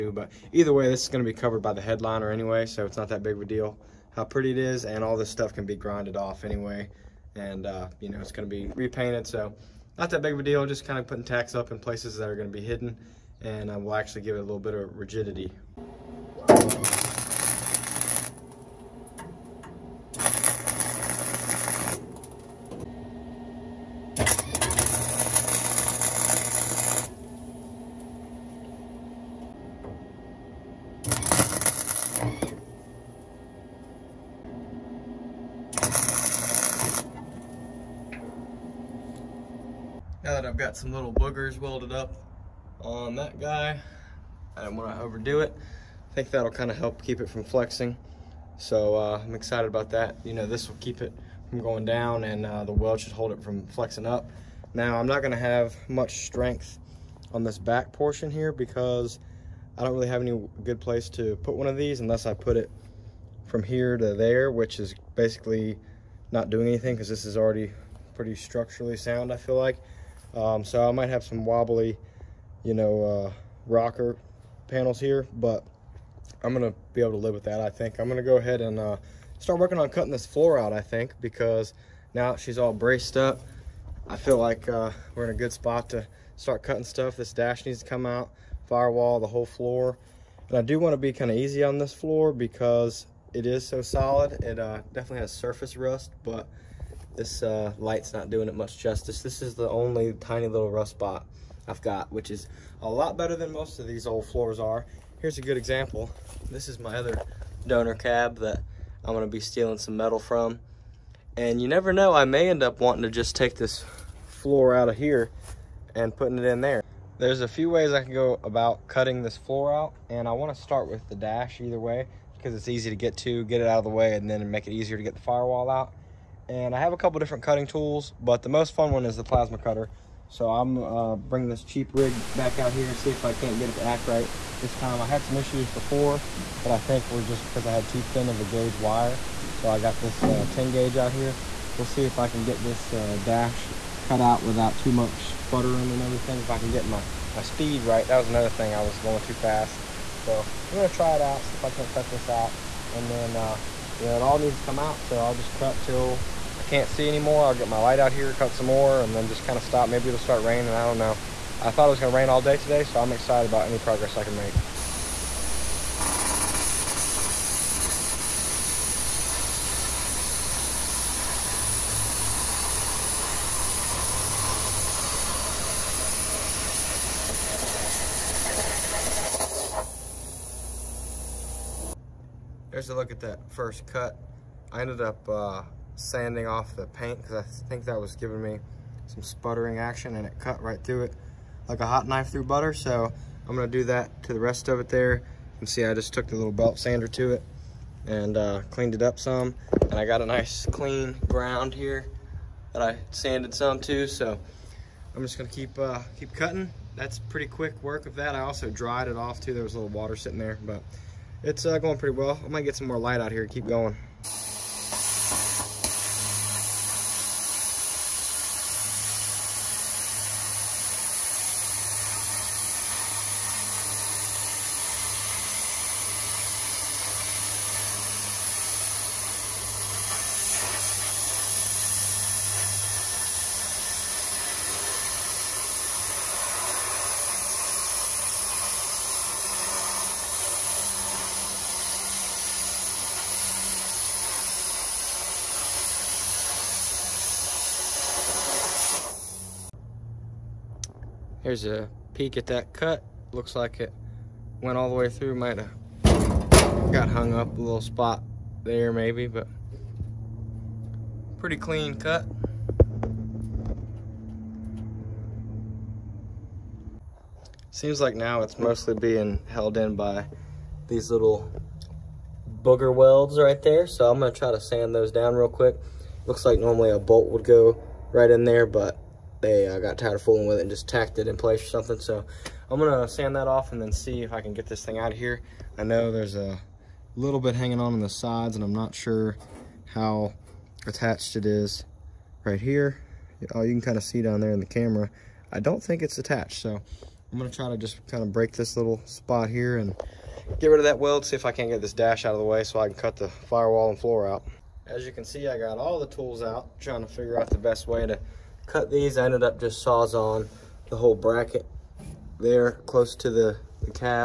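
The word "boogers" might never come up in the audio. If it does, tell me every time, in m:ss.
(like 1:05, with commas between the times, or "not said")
0:41, 4:32.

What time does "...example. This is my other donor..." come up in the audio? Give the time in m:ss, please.
1:45.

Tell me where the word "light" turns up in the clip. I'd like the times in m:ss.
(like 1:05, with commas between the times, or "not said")
1:37, 2:37, 3:32.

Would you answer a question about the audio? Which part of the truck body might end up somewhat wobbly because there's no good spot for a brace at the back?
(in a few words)
rocker panels.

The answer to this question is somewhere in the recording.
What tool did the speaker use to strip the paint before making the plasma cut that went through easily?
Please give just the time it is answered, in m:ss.
3:16.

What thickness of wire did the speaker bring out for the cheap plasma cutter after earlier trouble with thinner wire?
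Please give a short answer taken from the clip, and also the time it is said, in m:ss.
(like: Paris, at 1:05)
10 gauge, at 2:20.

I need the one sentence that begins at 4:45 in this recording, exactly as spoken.
I know there's a little bit hanging on in the sides and I'm not sure how attached it is right here.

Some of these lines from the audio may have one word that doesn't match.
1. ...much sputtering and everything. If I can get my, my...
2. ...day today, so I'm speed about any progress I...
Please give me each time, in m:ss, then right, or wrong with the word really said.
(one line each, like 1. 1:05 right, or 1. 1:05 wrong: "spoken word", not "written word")
1. 2:24 right
2. 2:42 wrong: "excited", not "speed".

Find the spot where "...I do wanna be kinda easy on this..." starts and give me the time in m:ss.
1:30.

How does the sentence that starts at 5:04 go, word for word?
As you can see, I got all the tools out, trying to figure out the best way to cut these.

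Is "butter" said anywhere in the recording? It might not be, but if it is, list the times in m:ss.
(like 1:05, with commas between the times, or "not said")
3:12.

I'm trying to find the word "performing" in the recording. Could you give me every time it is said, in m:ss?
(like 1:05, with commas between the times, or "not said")
not said.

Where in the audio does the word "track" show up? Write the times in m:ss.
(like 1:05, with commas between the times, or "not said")
not said.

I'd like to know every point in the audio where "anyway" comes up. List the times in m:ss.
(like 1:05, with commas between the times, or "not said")
0:02, 0:06.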